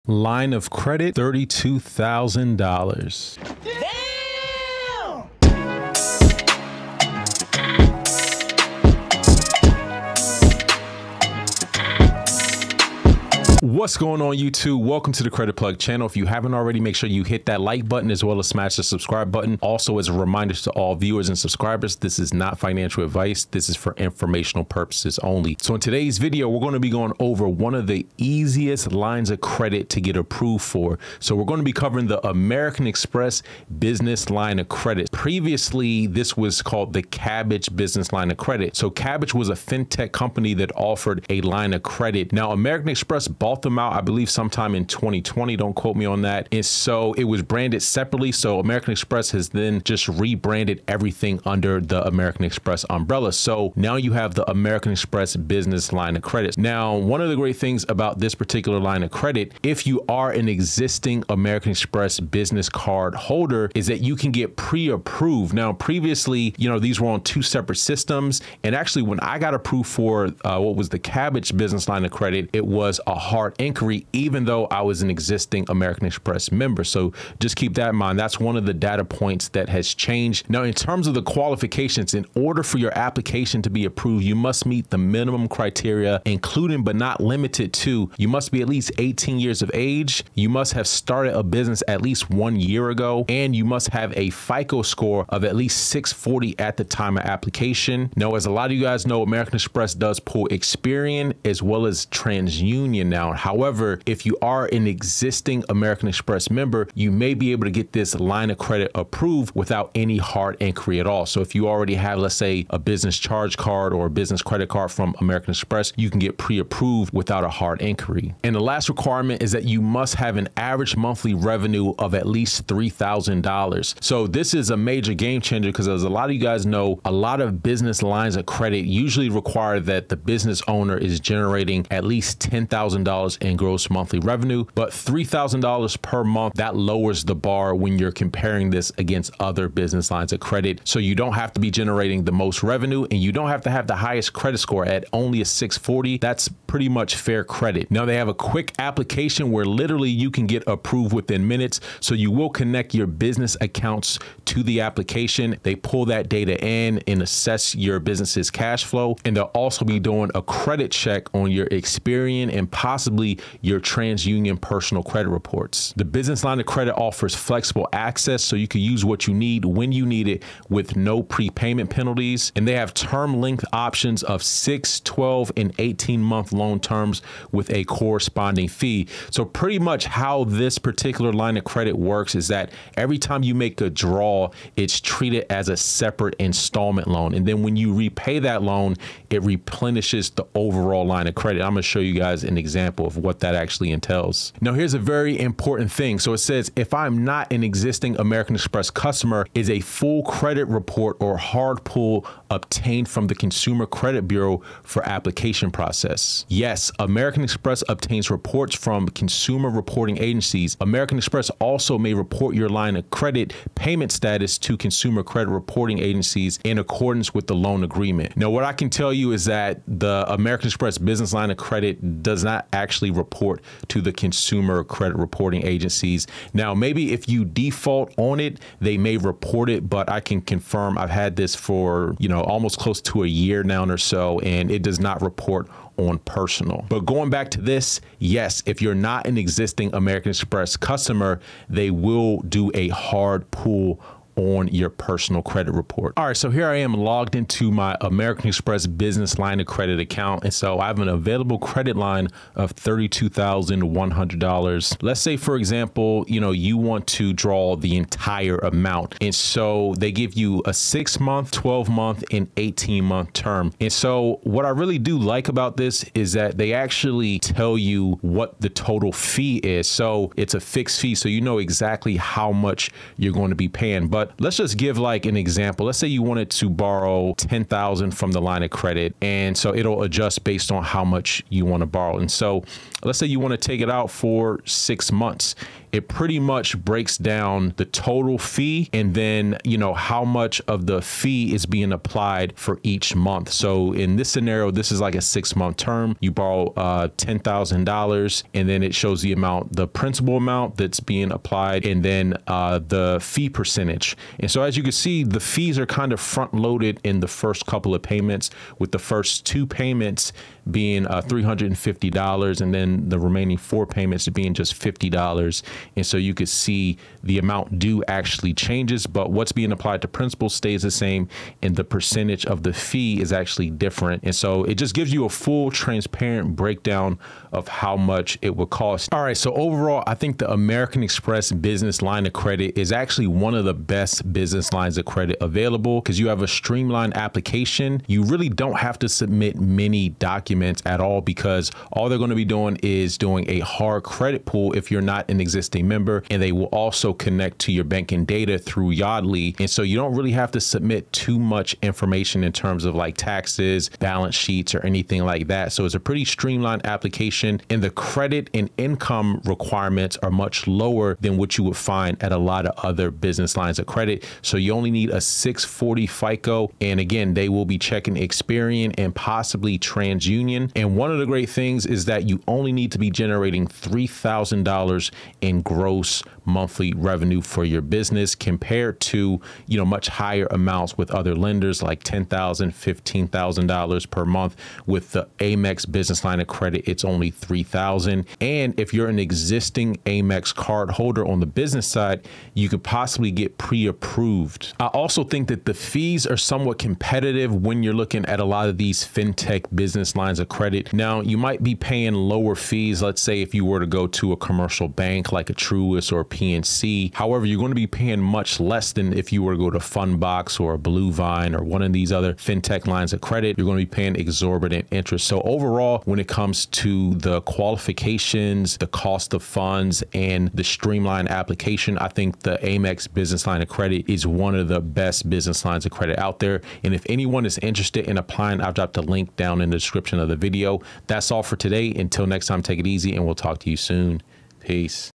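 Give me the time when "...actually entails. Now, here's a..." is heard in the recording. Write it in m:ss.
3:13.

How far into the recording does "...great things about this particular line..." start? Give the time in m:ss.
0:57.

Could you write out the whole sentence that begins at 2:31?
So you will connect your business accounts to the application.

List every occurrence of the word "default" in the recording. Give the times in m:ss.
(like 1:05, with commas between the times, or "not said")
3:47.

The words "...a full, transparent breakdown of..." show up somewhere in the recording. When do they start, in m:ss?
5:25.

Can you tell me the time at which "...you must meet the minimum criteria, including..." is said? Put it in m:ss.
1:24.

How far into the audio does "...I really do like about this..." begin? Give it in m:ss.
4:24.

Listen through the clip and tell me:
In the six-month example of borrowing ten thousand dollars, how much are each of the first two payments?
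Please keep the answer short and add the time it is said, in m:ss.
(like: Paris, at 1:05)
$350, at 5:11.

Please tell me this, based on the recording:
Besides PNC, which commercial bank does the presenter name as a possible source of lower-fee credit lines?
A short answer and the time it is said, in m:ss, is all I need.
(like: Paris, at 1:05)
Truist, at 6:45.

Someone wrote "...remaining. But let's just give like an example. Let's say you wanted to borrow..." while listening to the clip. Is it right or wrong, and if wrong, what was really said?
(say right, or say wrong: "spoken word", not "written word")
wrong: "paying", not "remaining".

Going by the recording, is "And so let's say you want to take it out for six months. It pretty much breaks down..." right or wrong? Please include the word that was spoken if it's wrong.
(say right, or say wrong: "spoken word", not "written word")
right.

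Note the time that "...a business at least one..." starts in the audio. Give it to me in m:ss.
1:31.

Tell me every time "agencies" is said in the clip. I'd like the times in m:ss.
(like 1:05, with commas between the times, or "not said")
3:30, 3:35, 3:45.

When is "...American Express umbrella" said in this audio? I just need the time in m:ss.
0:52.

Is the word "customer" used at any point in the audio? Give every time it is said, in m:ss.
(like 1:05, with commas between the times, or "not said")
3:18, 4:00.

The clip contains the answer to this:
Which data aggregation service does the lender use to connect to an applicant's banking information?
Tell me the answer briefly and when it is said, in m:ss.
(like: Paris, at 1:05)
Yodlee, at 5:48.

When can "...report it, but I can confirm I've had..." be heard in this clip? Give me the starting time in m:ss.
3:49.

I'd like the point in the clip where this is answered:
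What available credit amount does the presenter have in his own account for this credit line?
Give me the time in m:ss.
4:12.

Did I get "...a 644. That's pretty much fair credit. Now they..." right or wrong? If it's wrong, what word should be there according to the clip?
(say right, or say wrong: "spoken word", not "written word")
wrong: "640", not "644".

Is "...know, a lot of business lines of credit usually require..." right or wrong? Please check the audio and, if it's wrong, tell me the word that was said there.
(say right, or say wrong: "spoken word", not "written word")
right.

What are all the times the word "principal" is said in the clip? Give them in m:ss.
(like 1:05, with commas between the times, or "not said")
4:59, 5:20.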